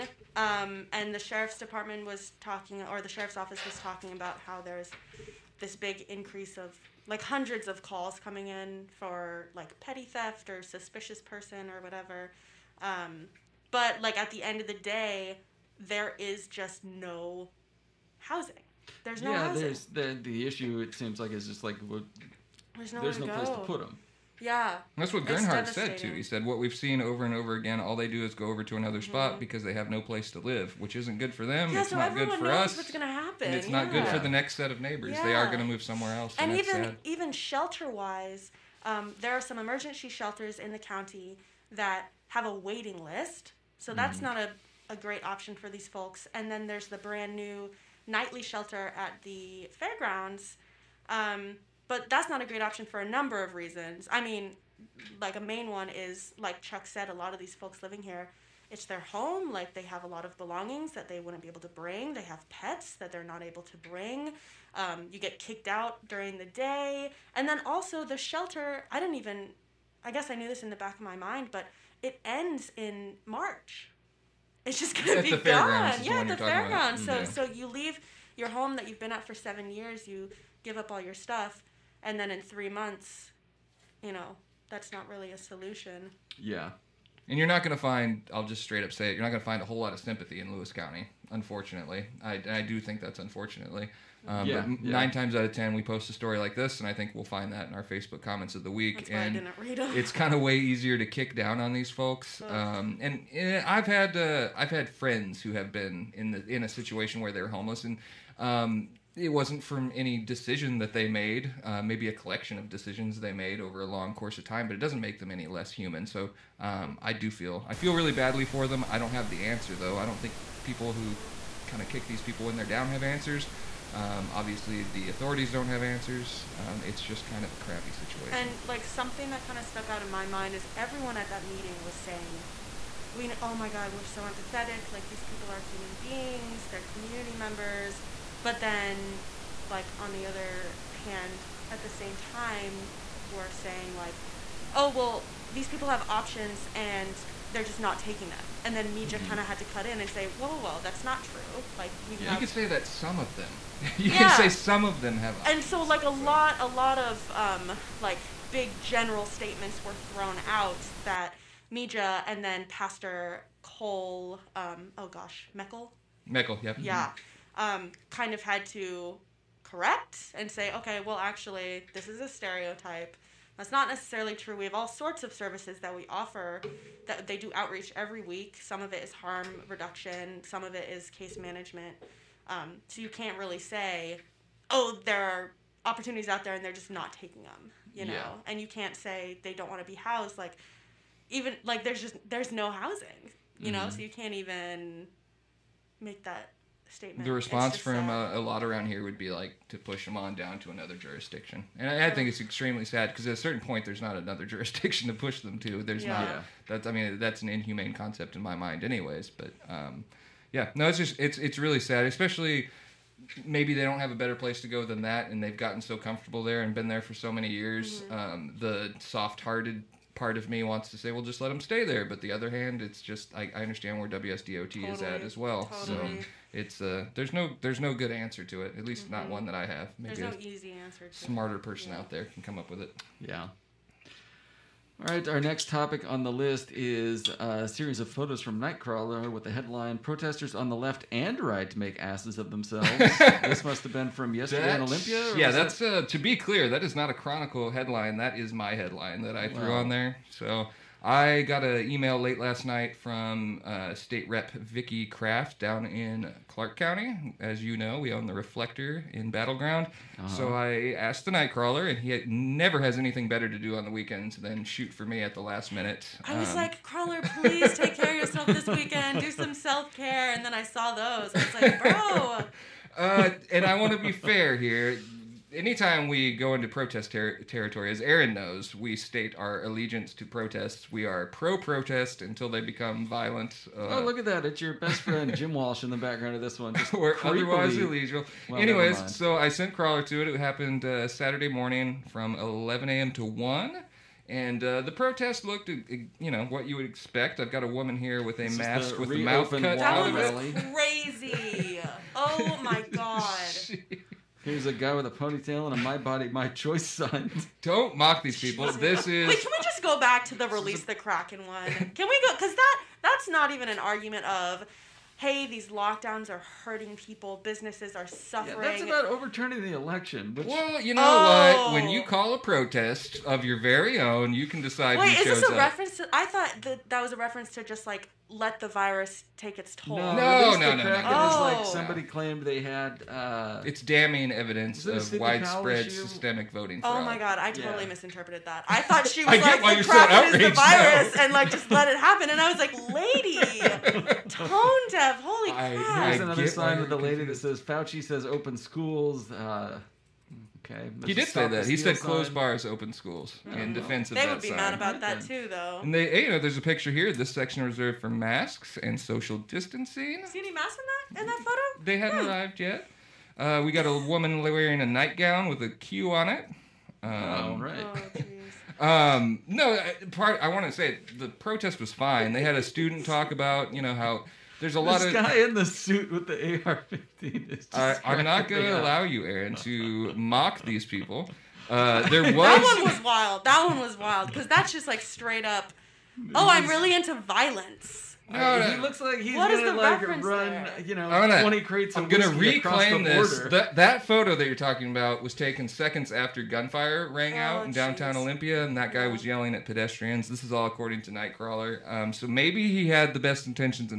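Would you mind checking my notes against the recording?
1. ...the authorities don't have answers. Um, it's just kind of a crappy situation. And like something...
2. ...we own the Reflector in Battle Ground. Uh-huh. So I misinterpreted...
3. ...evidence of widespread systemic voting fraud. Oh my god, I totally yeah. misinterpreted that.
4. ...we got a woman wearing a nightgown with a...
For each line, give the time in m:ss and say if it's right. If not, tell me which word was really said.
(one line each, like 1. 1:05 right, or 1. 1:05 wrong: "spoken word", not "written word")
1. 2:04 right
2. 4:17 wrong: "asked", not "misinterpreted"
3. 5:34 right
4. 6:03 right.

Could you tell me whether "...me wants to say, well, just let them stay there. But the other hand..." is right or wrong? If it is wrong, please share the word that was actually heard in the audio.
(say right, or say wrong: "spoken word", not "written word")
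right.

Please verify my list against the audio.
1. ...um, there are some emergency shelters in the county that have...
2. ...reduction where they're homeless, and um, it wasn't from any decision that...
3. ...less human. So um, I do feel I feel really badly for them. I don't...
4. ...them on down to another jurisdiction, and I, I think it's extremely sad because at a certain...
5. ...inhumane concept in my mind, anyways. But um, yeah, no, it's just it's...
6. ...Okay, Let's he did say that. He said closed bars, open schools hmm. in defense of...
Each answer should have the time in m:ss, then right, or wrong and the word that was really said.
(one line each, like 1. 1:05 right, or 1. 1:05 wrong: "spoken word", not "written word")
1. 0:38 right
2. 1:46 wrong: "situation", not "reduction"
3. 1:55 right
4. 3:20 right
5. 3:27 right
6. 5:50 right.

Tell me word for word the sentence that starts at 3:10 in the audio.
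Like, even like there's just there's no housing, you mm-hmm.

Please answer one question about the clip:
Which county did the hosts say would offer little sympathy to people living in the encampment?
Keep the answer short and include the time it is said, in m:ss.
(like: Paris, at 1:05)
Lewis County, at 1:30.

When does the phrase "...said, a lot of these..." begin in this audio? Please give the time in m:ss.
0:56.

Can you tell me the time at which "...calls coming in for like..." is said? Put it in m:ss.
0:07.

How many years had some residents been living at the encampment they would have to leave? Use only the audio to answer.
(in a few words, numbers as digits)
7.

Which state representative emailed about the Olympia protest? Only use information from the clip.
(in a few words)
Vicki Kraft.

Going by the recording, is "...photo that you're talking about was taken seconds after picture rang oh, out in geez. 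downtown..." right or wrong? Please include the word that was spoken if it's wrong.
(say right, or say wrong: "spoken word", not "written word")
wrong: "gunfire", not "picture".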